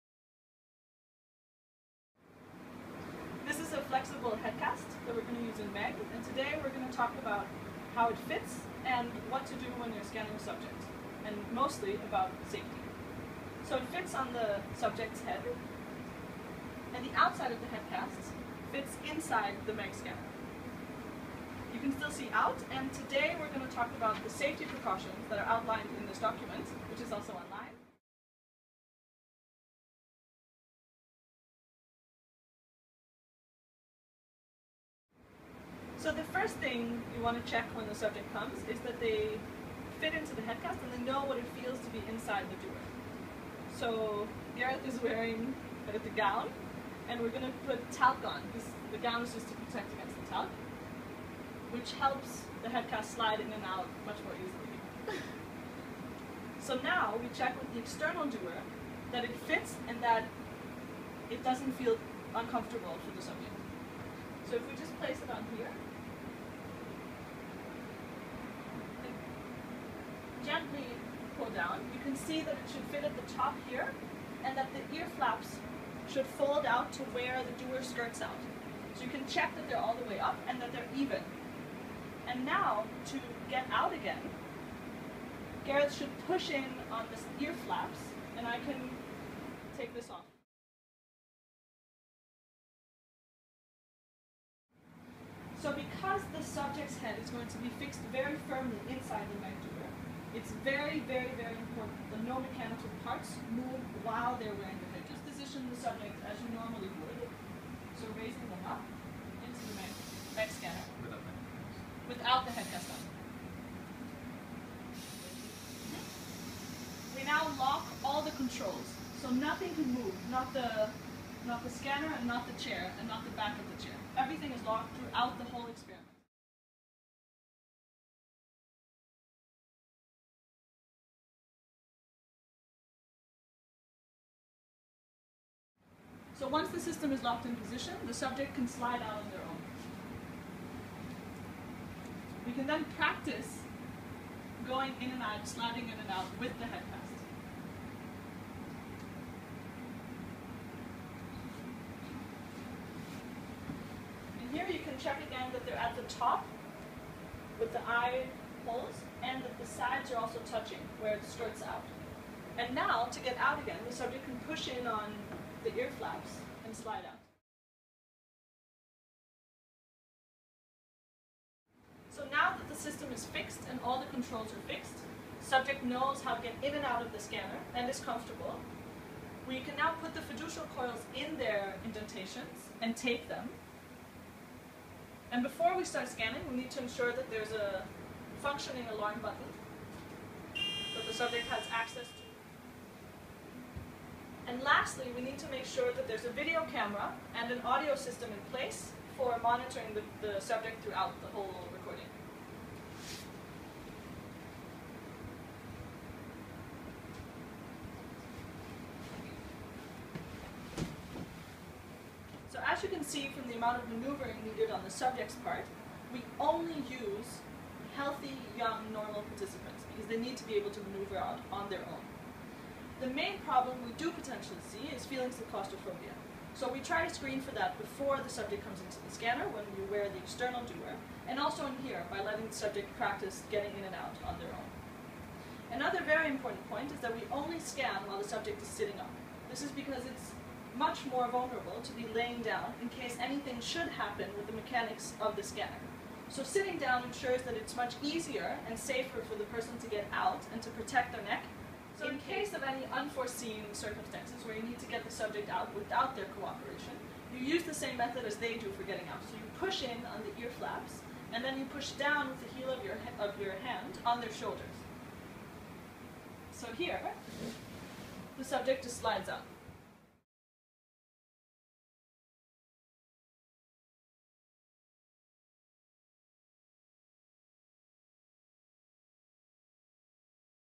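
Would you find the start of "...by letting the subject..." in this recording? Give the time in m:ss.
3:52.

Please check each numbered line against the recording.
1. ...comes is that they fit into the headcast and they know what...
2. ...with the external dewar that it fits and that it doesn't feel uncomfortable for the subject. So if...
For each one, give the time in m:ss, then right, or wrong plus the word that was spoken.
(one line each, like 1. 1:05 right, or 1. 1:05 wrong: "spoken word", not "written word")
1. 0:38 right
2. 0:57 right.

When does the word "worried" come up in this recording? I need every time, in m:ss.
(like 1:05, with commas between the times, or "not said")
not said.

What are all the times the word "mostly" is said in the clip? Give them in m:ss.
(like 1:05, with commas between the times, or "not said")
0:11.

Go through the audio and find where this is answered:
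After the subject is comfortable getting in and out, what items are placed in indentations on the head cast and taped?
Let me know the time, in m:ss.
3:00.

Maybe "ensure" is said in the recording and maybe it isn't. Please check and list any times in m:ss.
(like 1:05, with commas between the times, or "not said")
3:06, 4:07.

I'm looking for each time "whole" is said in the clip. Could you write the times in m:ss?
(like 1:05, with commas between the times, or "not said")
2:05, 3:21.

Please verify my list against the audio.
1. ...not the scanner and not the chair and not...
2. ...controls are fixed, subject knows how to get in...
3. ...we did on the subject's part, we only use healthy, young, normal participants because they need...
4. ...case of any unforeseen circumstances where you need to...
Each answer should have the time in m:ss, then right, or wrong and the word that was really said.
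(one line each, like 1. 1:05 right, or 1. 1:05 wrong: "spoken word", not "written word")
1. 2:01 right
2. 2:54 right
3. 3:34 right
4. 4:12 right.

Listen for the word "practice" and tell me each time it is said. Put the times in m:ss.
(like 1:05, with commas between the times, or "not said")
2:22, 3:52.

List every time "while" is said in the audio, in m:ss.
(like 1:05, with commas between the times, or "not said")
1:44, 3:58.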